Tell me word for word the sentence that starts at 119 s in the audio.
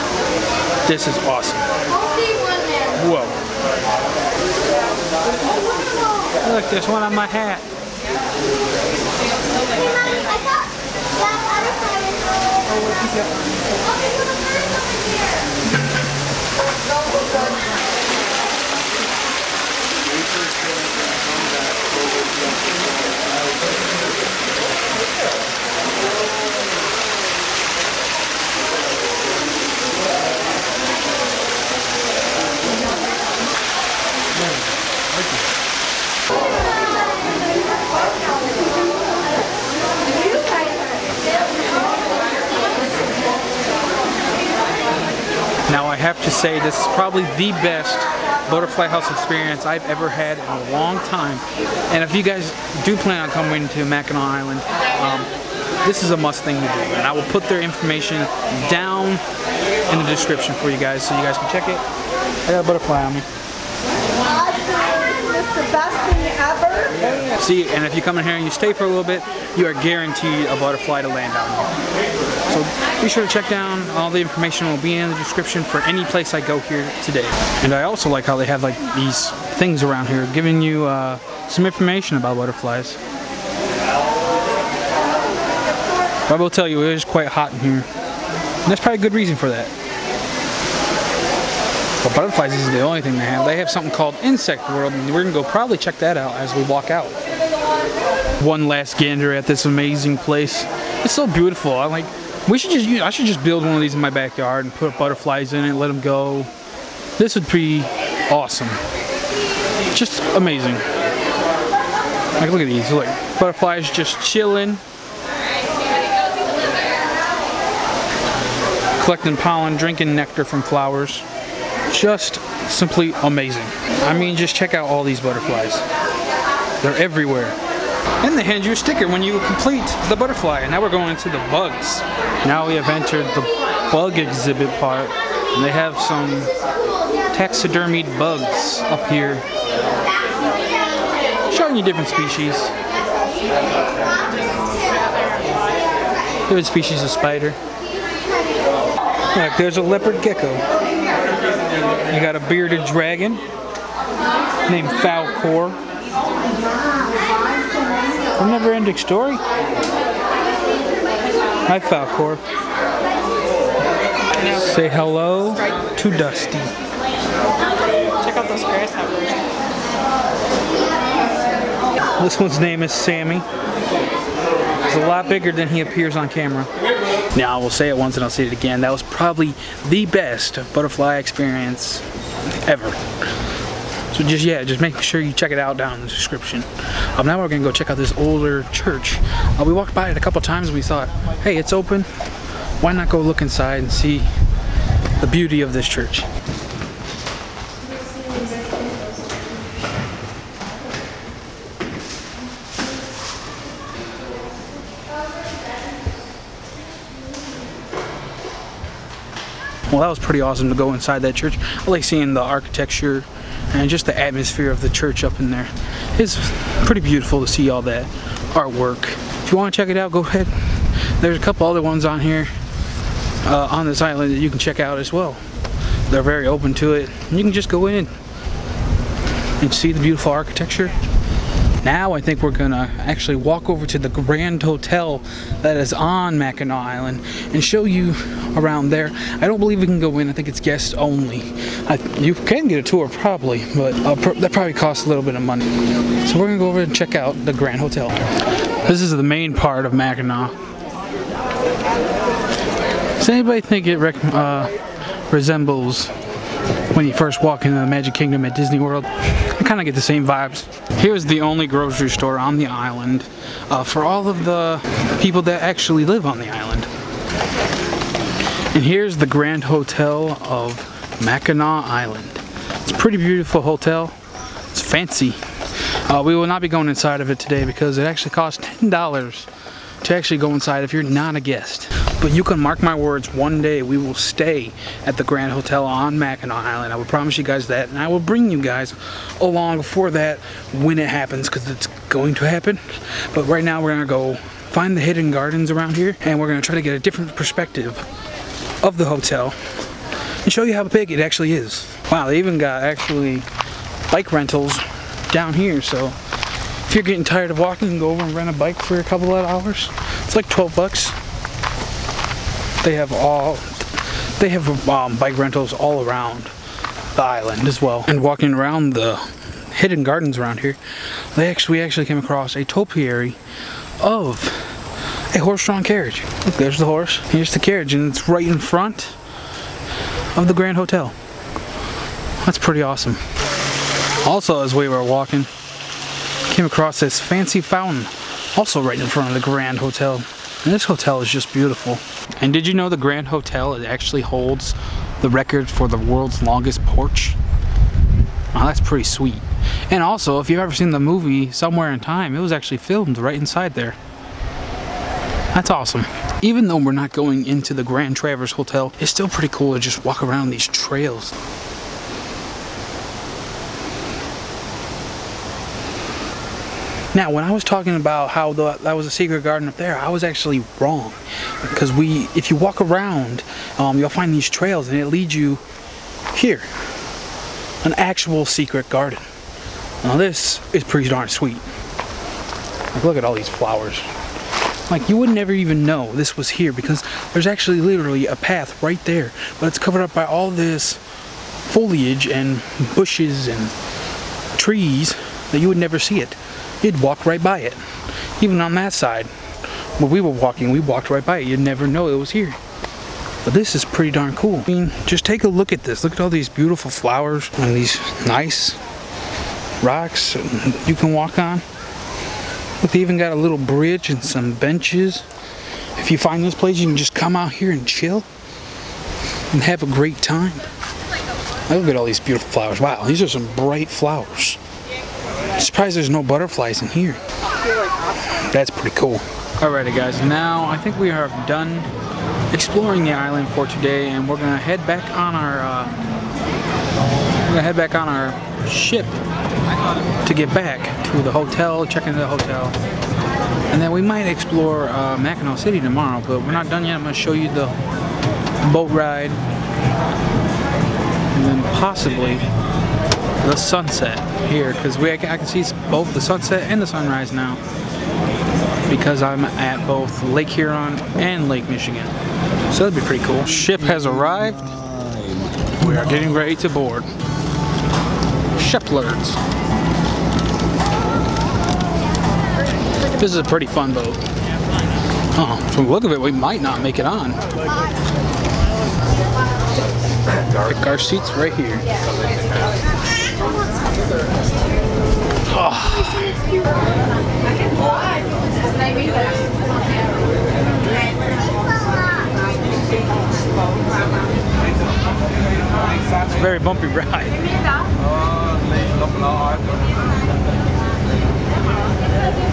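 collecting pollen, drinking nectar from flowers.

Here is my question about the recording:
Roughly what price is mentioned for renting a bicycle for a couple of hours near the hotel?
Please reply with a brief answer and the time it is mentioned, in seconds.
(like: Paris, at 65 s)
12 bucks, at 310 s.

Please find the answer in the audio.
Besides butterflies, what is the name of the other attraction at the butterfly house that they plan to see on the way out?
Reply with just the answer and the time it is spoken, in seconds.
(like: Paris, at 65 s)
Insect World, at 94 s.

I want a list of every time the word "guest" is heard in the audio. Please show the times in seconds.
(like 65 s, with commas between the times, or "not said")
240 s, 281 s.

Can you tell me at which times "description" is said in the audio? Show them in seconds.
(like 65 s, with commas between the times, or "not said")
60 s, 75 s, 186 s.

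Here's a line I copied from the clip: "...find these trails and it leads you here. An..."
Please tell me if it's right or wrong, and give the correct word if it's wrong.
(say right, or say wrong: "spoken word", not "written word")
right.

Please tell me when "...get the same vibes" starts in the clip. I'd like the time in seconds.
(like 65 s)
259 s.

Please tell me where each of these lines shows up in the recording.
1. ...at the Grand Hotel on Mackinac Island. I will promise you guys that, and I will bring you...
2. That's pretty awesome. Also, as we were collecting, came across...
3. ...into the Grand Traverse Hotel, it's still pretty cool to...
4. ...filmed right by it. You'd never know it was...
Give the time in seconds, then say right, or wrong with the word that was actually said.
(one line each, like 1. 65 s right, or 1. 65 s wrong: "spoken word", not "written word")
1. 285 s right
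2. 332 s wrong: "walking", not "collecting"
3. 357 s right
4. 400 s wrong: "walked", not "filmed".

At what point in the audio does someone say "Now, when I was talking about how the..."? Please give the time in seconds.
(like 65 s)
367 s.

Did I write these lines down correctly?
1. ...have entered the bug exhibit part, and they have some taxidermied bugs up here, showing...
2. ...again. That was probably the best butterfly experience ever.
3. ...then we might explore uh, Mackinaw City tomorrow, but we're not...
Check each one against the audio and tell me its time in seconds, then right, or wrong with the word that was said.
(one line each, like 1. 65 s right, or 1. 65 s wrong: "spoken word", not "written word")
1. 132 s right
2. 178 s right
3. 443 s right.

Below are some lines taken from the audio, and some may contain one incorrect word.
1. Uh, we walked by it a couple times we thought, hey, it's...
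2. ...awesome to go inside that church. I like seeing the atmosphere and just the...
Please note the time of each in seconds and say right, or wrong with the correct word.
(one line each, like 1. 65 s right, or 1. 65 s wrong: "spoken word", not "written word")
1. 189 s right
2. 210 s wrong: "architecture", not "atmosphere".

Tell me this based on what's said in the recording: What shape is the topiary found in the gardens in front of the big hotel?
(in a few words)
horse-drawn carriage.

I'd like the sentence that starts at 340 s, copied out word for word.
And this hotel is just beautiful.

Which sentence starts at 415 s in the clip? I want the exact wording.
If you find this place, you can just come out here and chill and have a great time.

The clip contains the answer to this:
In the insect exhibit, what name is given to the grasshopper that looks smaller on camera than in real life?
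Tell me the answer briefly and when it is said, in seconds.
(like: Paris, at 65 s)
Sammy, at 172 s.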